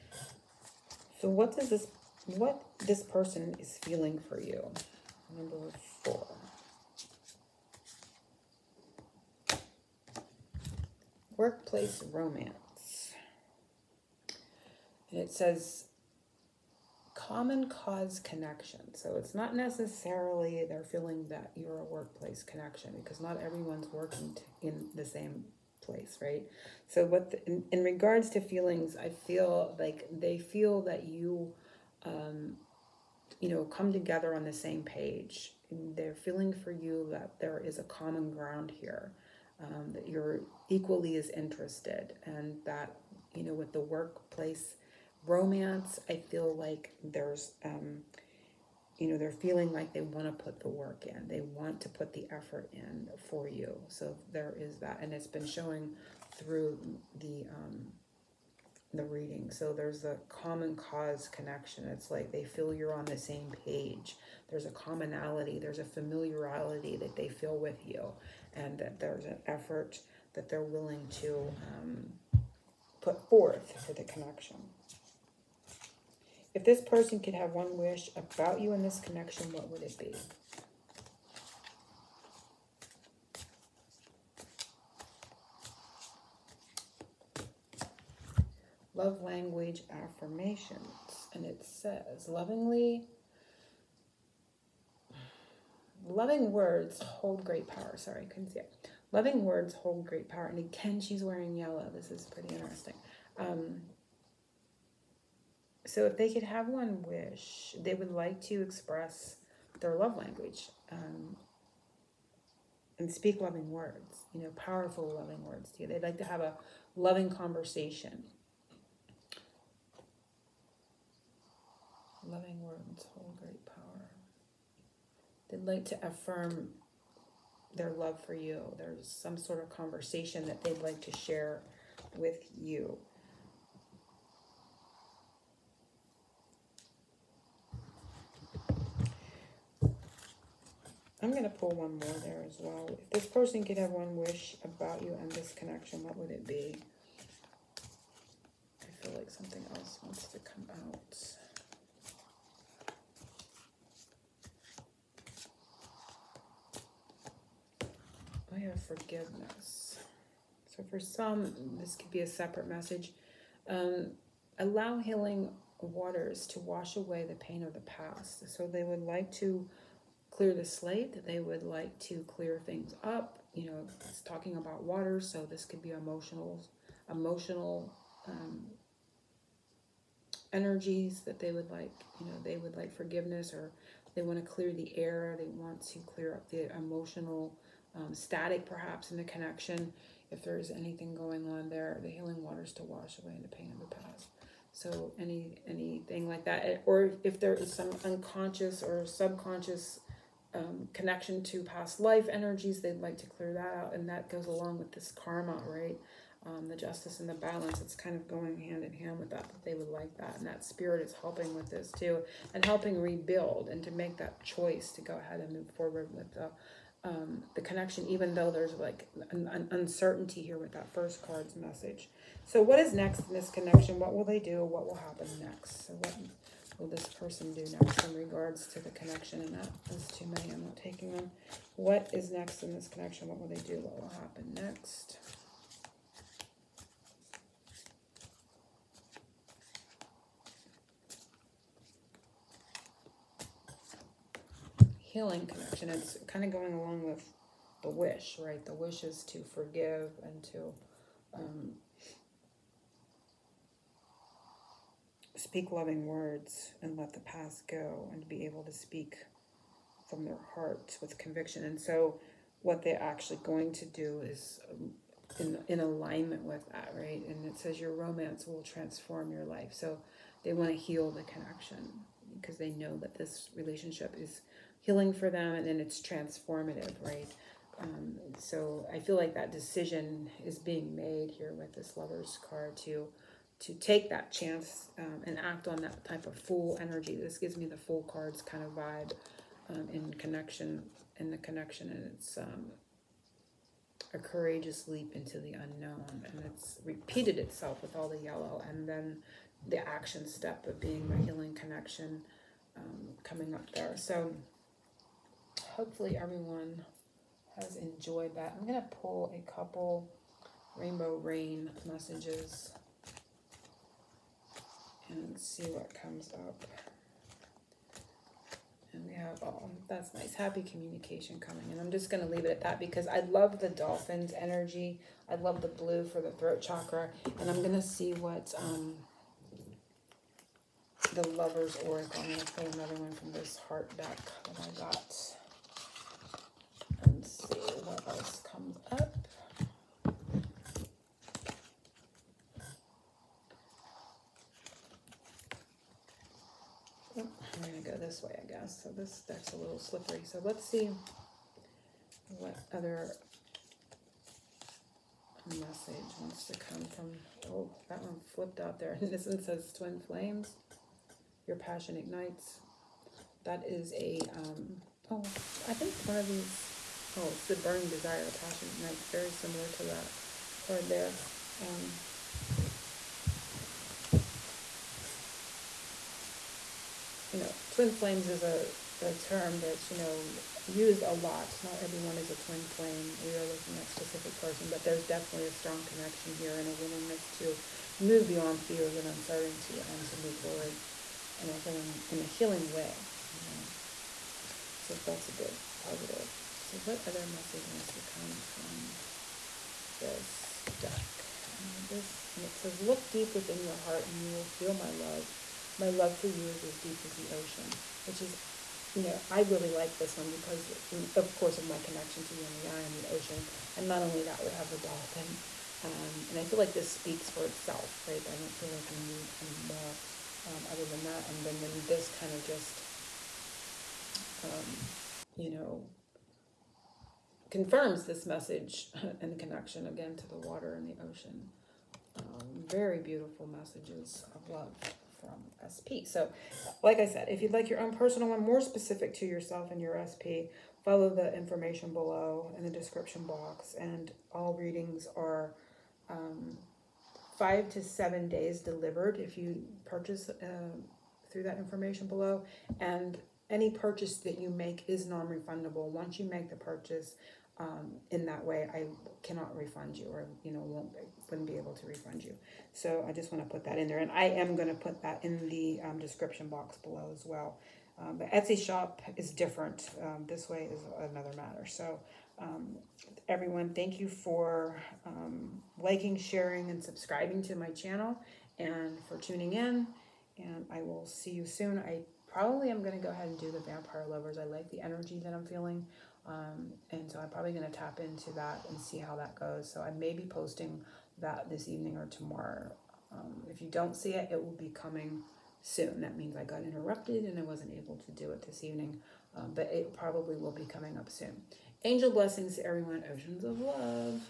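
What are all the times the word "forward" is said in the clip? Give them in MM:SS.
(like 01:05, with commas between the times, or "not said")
03:35, 06:30.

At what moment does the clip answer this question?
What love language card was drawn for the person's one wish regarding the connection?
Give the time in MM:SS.
01:29.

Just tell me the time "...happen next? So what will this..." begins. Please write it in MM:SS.
03:44.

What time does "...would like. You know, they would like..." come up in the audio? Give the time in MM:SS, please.
03:01.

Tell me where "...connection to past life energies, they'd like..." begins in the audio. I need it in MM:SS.
03:20.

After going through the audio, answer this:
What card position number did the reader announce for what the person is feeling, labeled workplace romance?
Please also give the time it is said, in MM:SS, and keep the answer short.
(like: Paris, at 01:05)
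4, at 00:05.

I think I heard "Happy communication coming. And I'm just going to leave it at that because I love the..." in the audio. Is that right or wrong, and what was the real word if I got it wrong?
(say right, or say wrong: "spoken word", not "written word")
right.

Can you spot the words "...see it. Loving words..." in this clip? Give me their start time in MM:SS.
01:38.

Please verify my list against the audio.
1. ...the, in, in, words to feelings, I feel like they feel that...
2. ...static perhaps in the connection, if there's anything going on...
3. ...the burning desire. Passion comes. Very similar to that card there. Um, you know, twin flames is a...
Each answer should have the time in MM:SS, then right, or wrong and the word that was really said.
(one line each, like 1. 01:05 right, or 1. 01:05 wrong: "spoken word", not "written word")
1. 00:27 wrong: "regards", not "words"
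2. 03:08 right
3. 06:07 wrong: "ignites", not "comes".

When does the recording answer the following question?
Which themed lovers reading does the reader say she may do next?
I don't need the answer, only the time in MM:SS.
08:03.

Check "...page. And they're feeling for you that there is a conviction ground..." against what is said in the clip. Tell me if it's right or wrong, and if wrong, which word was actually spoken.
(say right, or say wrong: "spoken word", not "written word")
wrong: "common", not "conviction".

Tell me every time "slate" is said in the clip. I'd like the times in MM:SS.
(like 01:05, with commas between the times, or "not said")
02:50.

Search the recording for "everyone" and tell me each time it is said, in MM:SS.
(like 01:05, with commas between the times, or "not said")
00:23, 05:06, 06:21, 07:53, 08:22.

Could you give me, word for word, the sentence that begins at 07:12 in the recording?
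Um, very beautiful messages of love from SP.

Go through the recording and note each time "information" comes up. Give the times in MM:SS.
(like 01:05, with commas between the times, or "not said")
07:21, 07:31.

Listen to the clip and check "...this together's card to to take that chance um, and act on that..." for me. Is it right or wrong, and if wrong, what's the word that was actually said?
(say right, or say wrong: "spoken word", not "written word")
wrong: "lover", not "together".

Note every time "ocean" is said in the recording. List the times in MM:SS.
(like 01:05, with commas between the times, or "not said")
06:47, 06:53, 07:11, 08:23.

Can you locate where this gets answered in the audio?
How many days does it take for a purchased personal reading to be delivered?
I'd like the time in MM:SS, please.
07:27.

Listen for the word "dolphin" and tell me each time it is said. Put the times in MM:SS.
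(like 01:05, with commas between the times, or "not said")
05:23, 06:54.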